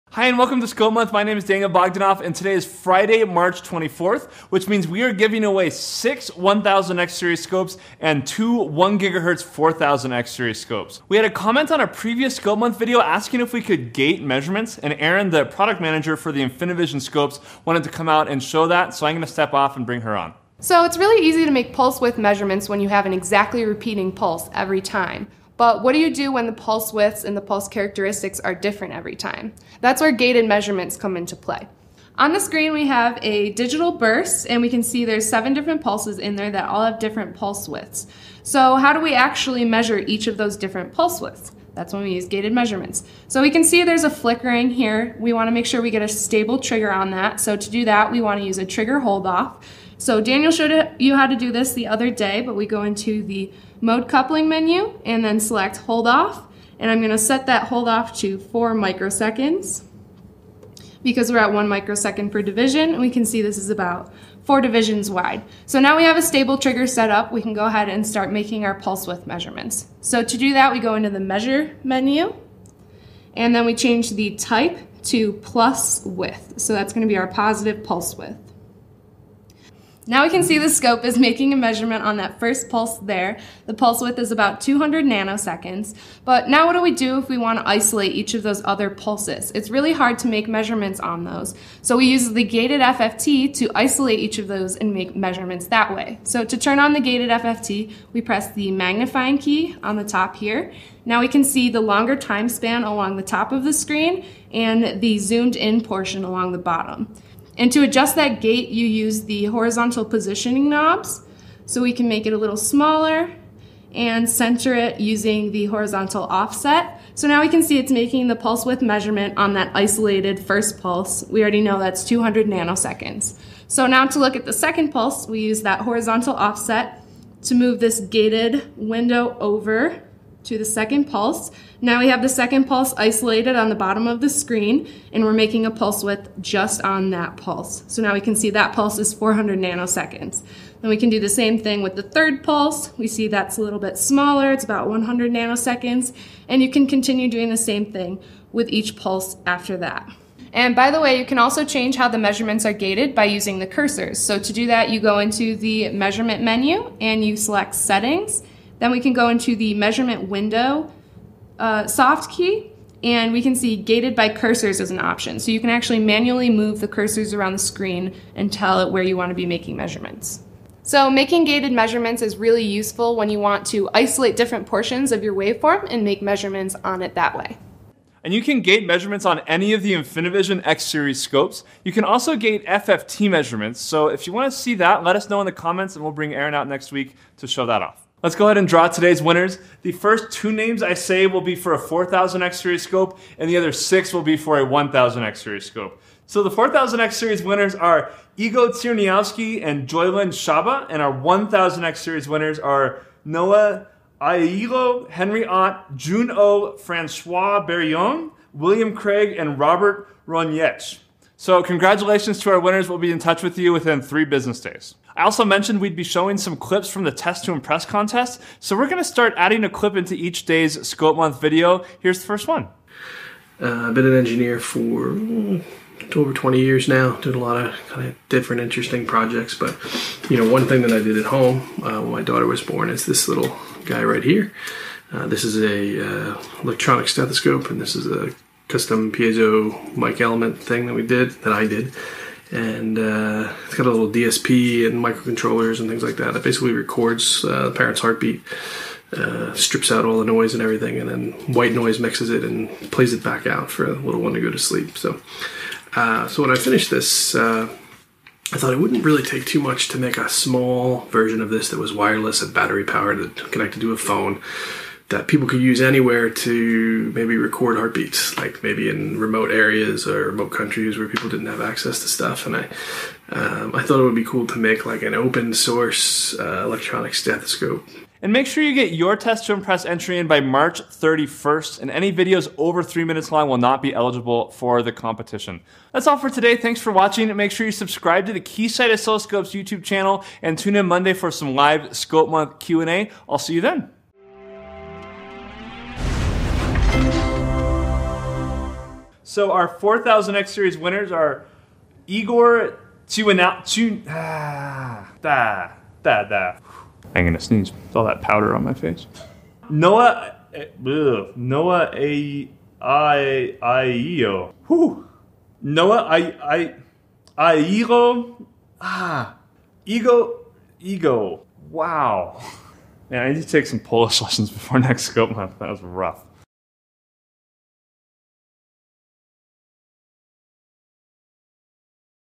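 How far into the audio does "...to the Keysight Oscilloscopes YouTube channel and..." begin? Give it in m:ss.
4:48.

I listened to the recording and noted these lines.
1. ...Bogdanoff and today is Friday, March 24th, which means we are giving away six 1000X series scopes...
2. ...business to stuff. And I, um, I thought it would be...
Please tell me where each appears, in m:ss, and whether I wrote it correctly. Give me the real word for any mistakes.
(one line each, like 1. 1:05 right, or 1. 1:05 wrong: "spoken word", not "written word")
1. 0:01 right
2. 4:31 wrong: "access", not "business".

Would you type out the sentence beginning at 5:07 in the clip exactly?
I'm gonna sneeze with all that powder on my face.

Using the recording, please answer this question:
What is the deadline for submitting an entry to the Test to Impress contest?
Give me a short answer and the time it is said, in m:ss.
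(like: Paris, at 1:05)
March 31st, at 4:40.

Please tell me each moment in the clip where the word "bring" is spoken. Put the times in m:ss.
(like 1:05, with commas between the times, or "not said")
0:19, 3:06.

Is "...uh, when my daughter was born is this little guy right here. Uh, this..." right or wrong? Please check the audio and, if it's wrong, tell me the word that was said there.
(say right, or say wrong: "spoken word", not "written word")
right.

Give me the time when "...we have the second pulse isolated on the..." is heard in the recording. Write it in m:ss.
2:11.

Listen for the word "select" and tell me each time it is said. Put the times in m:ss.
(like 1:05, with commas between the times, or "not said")
0:55, 2:37.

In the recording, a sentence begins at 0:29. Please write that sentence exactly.
That's where gated measurements come into play.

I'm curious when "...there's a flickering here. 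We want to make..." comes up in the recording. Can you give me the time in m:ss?
0:43.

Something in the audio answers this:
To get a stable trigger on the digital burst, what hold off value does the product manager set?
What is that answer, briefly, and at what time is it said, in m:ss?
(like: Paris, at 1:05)
4 microseconds, at 0:58.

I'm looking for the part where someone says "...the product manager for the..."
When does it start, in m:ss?
0:15.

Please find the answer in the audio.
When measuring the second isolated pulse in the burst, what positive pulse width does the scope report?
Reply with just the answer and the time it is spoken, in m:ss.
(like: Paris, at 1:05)
400 nanoseconds, at 2:19.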